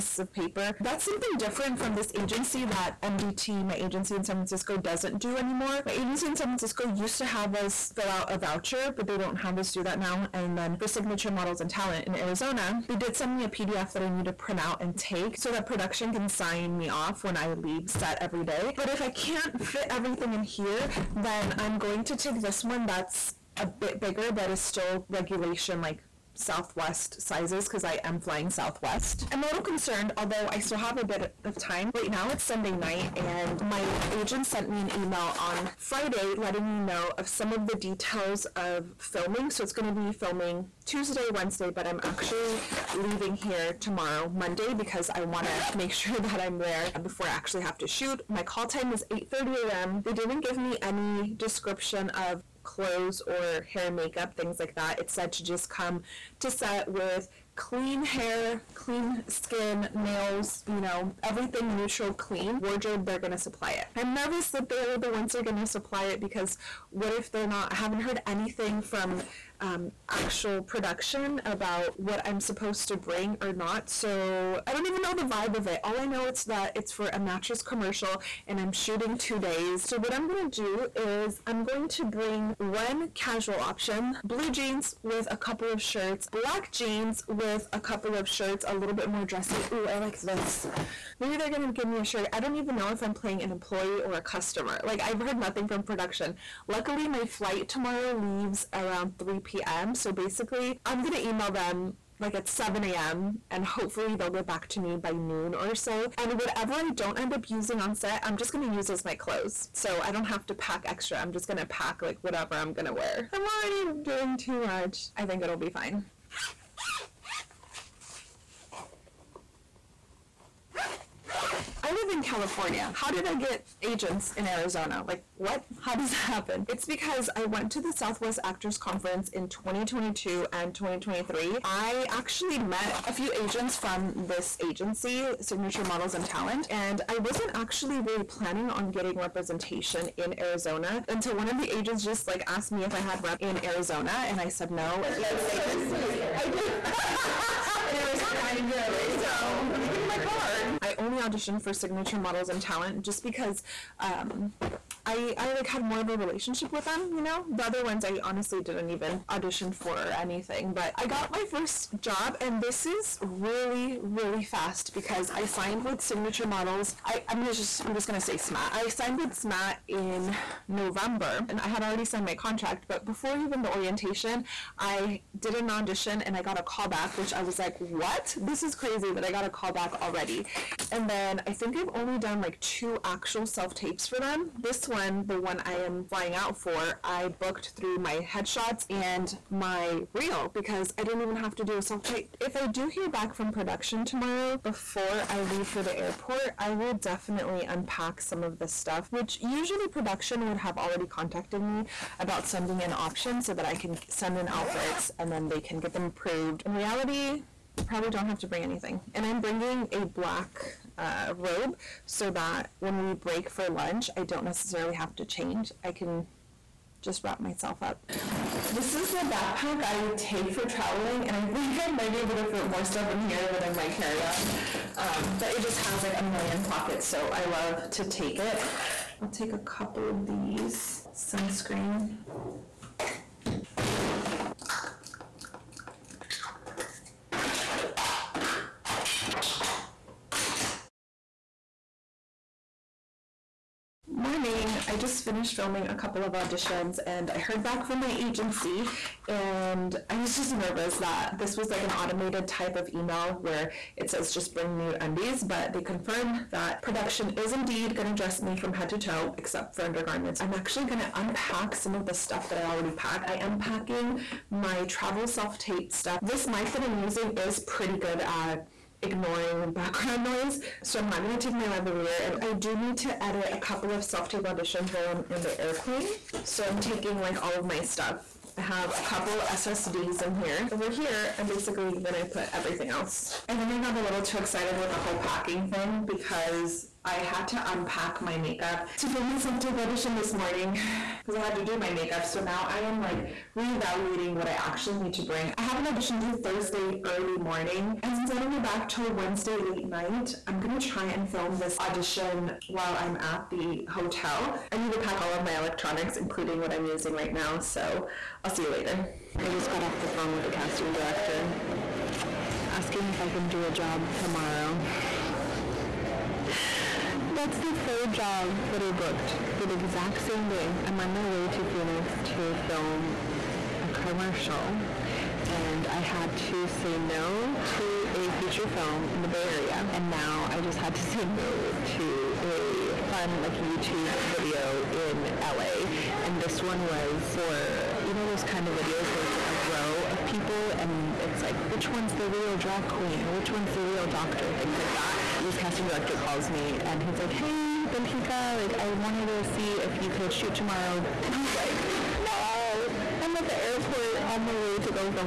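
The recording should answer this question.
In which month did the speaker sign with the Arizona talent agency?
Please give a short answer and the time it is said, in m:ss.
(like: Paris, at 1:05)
November, at 2:50.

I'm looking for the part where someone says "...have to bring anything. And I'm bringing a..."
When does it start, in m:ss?
3:28.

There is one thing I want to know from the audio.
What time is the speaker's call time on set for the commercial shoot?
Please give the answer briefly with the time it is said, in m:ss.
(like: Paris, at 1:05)
8:30 a.m., at 0:49.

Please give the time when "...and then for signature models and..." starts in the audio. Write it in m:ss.
0:10.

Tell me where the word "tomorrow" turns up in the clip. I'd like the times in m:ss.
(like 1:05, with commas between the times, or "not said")
0:43, 1:37, 3:14, 5:14, 5:50.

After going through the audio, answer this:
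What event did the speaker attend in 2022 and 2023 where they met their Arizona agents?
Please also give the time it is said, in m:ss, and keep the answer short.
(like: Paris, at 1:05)
Southwest Actors Conference, at 2:07.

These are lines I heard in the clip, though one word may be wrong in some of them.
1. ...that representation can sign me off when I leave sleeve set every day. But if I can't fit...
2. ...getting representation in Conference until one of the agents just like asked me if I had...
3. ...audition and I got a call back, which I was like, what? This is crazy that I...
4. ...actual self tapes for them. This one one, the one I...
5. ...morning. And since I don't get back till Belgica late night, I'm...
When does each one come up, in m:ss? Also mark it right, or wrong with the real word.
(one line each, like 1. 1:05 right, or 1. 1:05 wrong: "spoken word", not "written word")
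1. 0:15 wrong: "production", not "representation"
2. 2:18 wrong: "Arizona", not "Conference"
3. 2:55 right
4. 3:03 right
5. 4:57 wrong: "Wednesday", not "Belgica".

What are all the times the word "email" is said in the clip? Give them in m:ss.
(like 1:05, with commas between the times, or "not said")
0:34, 1:41, 4:12.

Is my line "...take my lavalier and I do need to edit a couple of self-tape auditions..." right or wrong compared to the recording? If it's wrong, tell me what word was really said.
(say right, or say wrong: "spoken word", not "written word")
right.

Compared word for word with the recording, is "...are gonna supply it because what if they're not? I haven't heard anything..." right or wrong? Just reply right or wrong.
right.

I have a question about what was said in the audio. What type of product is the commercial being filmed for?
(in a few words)
Mattress.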